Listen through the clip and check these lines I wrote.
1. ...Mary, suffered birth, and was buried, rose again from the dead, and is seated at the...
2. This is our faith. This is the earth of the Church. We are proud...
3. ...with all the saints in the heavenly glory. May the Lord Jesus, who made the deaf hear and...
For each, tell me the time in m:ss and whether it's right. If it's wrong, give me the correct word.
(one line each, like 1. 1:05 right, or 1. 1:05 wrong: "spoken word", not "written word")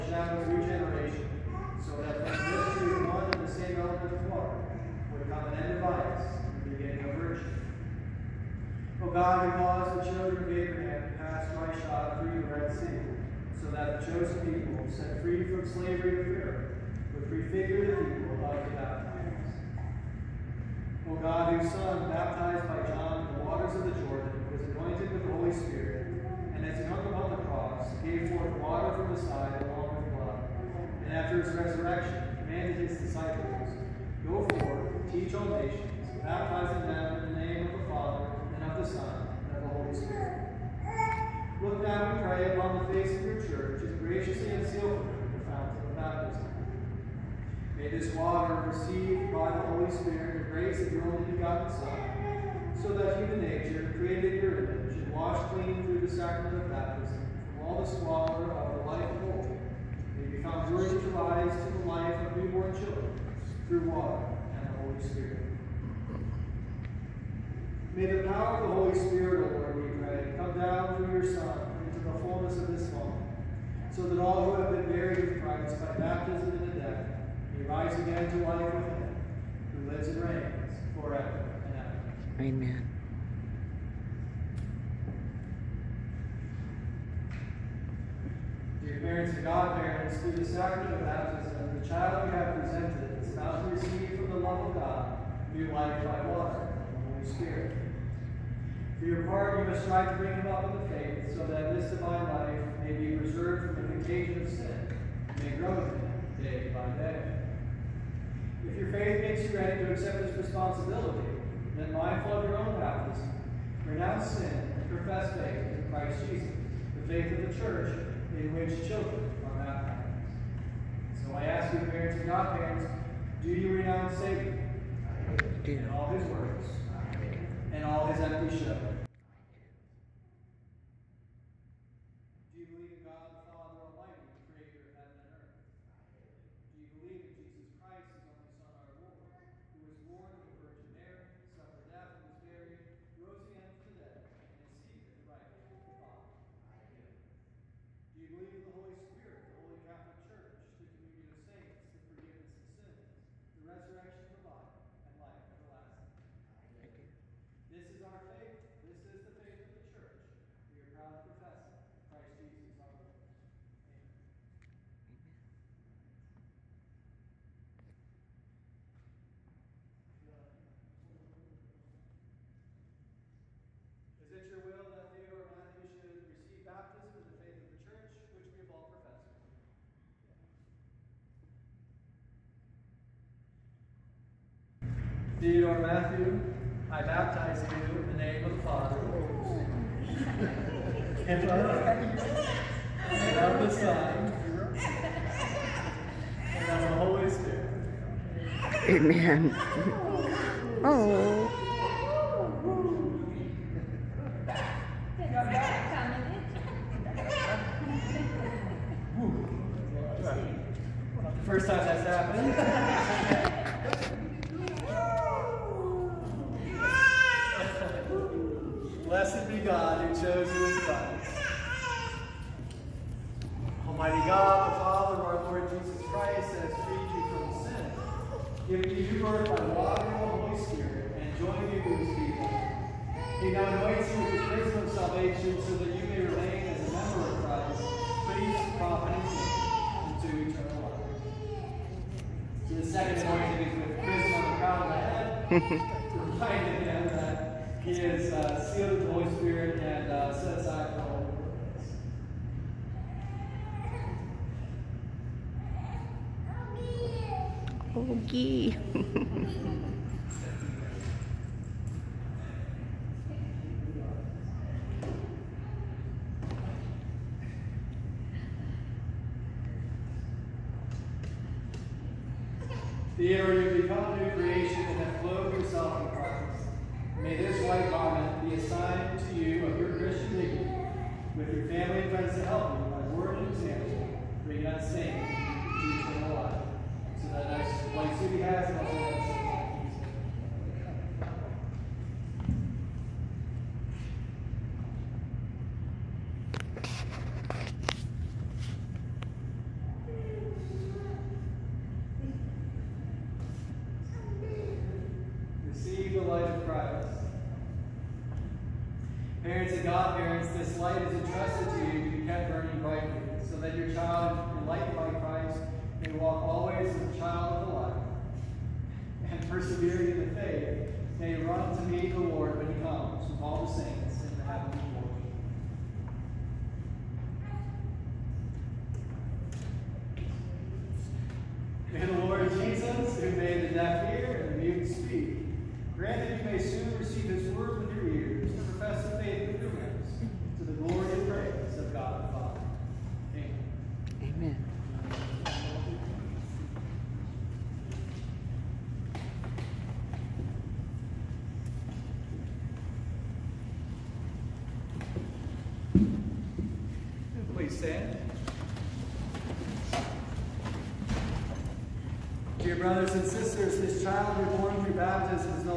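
1. 2:20 wrong: "death", not "birth"
2. 2:37 wrong: "faith", not "earth"
3. 5:23 right.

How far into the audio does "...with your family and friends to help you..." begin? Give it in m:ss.
4:41.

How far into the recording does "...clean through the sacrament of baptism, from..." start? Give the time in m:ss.
0:55.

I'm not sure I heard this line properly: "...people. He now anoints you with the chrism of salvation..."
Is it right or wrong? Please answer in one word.
right.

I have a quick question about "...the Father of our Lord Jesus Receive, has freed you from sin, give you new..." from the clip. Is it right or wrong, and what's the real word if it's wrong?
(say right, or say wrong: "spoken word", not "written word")
wrong: "Christ", not "Receive".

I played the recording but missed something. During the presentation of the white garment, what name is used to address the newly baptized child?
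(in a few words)
Theodore.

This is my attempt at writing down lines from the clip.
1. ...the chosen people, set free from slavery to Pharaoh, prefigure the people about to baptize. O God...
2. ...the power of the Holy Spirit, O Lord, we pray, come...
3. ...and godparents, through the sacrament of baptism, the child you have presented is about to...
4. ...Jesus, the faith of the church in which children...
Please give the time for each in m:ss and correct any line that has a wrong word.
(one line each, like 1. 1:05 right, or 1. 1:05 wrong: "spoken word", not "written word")
1. 0:13 right
2. 1:08 right
3. 1:29 right
4. 1:56 right.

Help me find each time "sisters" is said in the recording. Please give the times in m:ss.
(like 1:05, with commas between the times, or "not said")
6:03.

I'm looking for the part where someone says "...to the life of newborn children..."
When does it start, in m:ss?
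1:01.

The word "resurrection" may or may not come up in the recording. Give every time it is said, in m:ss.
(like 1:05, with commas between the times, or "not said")
0:31, 2:33.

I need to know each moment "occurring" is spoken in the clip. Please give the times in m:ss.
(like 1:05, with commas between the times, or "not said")
not said.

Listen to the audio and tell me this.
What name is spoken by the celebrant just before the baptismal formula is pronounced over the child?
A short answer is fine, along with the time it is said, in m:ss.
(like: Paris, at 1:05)
Matthew, at 3:05.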